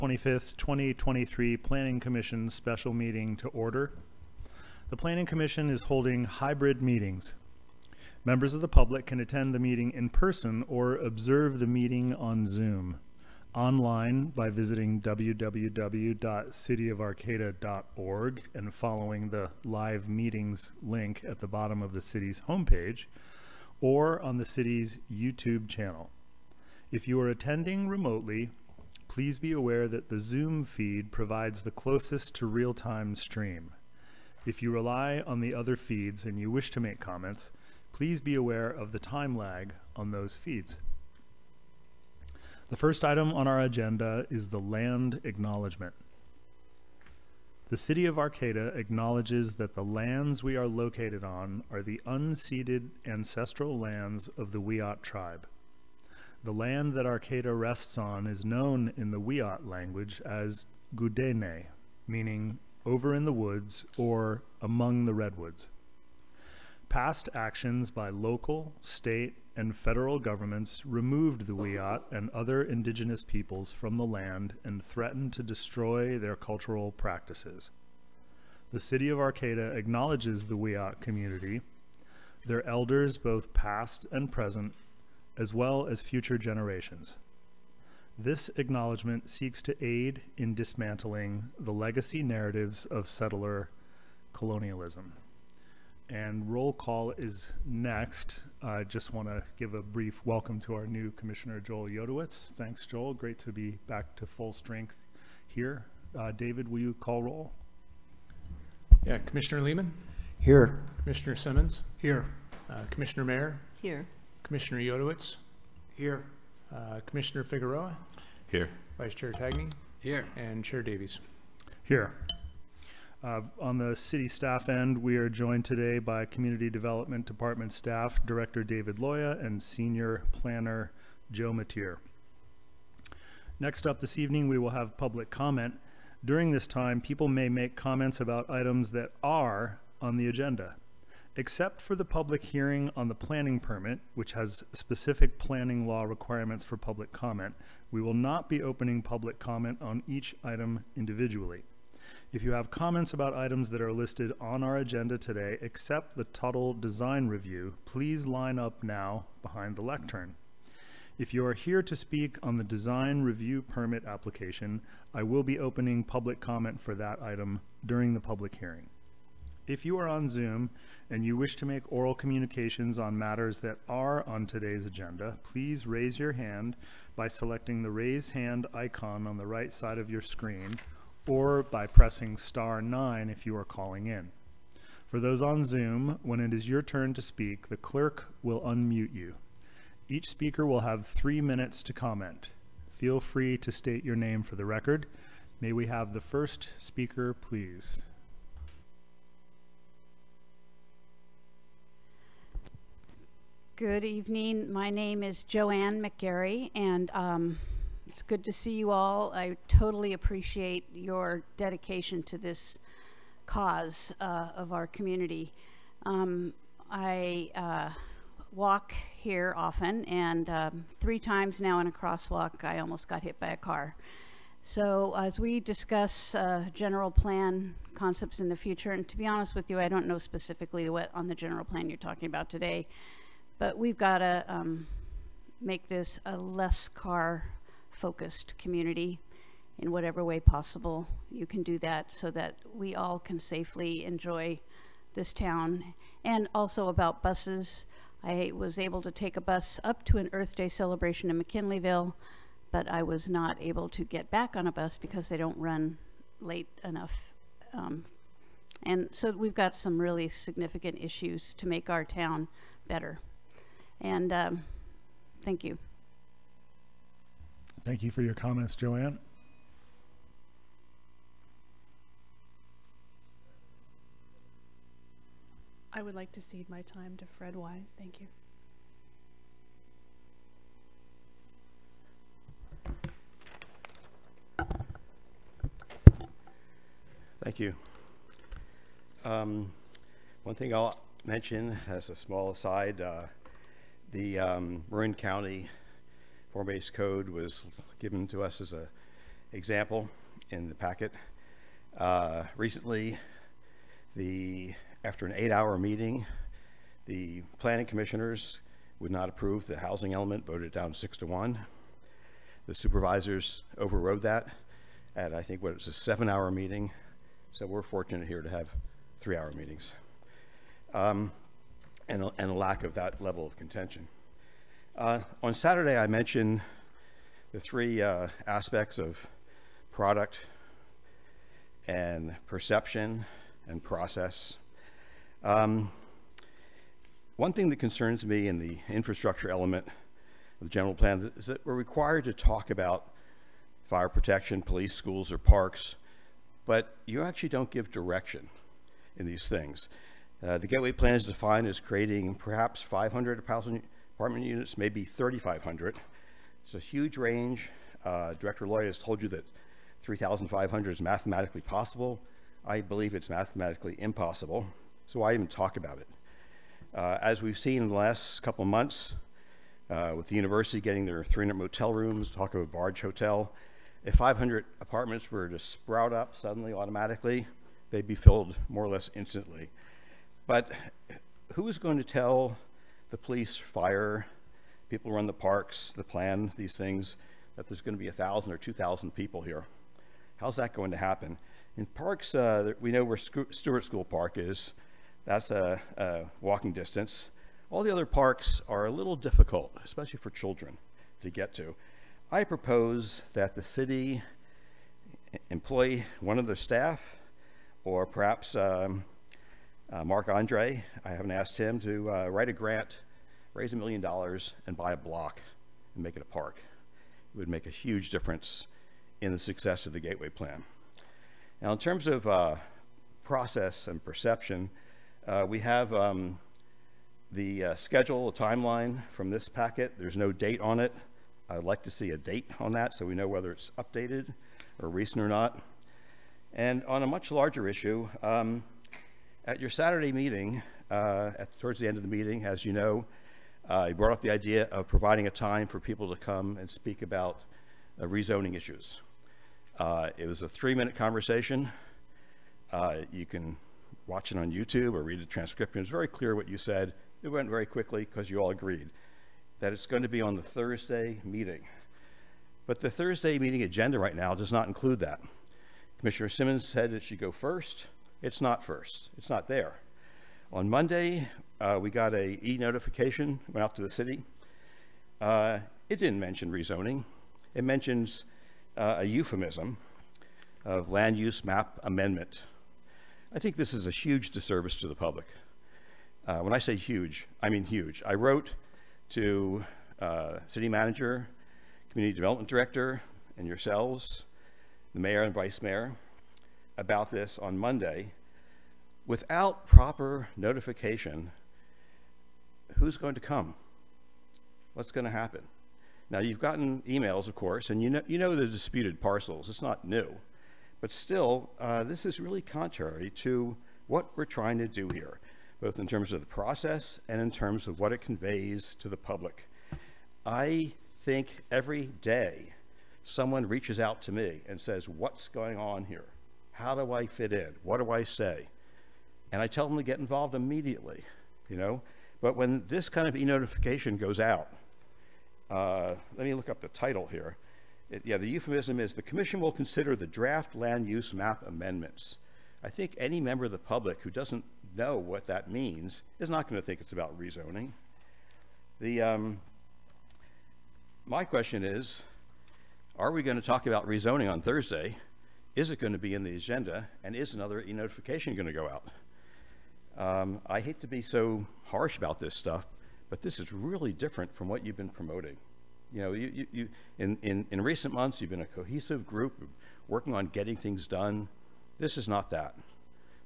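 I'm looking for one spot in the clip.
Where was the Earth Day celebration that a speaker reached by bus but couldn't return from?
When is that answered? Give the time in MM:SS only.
04:11.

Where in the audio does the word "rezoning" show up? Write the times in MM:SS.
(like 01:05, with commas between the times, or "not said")
07:28, 07:56, 09:07, 09:13.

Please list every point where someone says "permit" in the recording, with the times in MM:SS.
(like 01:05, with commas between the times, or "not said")
02:23, 02:43.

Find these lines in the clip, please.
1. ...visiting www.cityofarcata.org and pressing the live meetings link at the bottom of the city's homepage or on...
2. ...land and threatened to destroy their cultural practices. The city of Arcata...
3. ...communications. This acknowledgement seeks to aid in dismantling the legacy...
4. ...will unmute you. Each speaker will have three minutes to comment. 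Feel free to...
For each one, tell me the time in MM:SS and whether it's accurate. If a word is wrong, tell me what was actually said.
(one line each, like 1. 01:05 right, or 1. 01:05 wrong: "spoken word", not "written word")
1. 00:14 wrong: "following", not "pressing"
2. 01:14 right
3. 01:26 wrong: "generations", not "communications"
4. 03:08 right.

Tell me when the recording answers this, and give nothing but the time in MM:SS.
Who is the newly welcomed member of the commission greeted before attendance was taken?
01:41.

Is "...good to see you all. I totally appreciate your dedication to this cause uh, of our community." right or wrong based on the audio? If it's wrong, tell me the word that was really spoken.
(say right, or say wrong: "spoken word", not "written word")
right.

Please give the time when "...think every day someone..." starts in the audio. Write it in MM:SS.
08:41.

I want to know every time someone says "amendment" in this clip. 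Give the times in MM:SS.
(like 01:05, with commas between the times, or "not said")
08:01, 09:01.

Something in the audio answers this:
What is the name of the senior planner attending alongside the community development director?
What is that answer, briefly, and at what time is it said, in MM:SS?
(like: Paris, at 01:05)
Joe Matier, at 02:11.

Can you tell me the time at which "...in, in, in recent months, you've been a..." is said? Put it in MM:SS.
09:26.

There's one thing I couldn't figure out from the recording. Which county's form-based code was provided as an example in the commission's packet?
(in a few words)
Marin County.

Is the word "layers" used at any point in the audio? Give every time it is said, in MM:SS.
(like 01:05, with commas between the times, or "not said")
not said.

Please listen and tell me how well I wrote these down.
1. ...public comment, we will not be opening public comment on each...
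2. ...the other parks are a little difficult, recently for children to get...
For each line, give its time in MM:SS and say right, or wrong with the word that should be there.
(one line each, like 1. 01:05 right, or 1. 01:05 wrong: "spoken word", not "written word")
1. 02:26 right
2. 06:37 wrong: "especially", not "recently".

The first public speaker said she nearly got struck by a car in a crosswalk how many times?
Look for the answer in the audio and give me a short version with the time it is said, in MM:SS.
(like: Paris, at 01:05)
3, at 03:40.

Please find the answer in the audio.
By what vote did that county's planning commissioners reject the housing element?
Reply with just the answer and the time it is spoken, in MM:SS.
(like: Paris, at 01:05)
6 to 1, at 05:10.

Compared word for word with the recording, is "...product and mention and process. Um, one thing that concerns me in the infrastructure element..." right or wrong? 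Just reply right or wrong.
wrong.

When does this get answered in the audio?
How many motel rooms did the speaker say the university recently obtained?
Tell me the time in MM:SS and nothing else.
06:11.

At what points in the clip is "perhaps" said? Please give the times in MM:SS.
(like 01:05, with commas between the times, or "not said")
05:52, 06:48.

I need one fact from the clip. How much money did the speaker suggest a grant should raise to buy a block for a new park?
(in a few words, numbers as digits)
a million dollars.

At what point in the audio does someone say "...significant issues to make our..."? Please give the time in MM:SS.
04:20.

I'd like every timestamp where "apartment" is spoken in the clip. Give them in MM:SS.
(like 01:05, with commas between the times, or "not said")
05:53, 06:14.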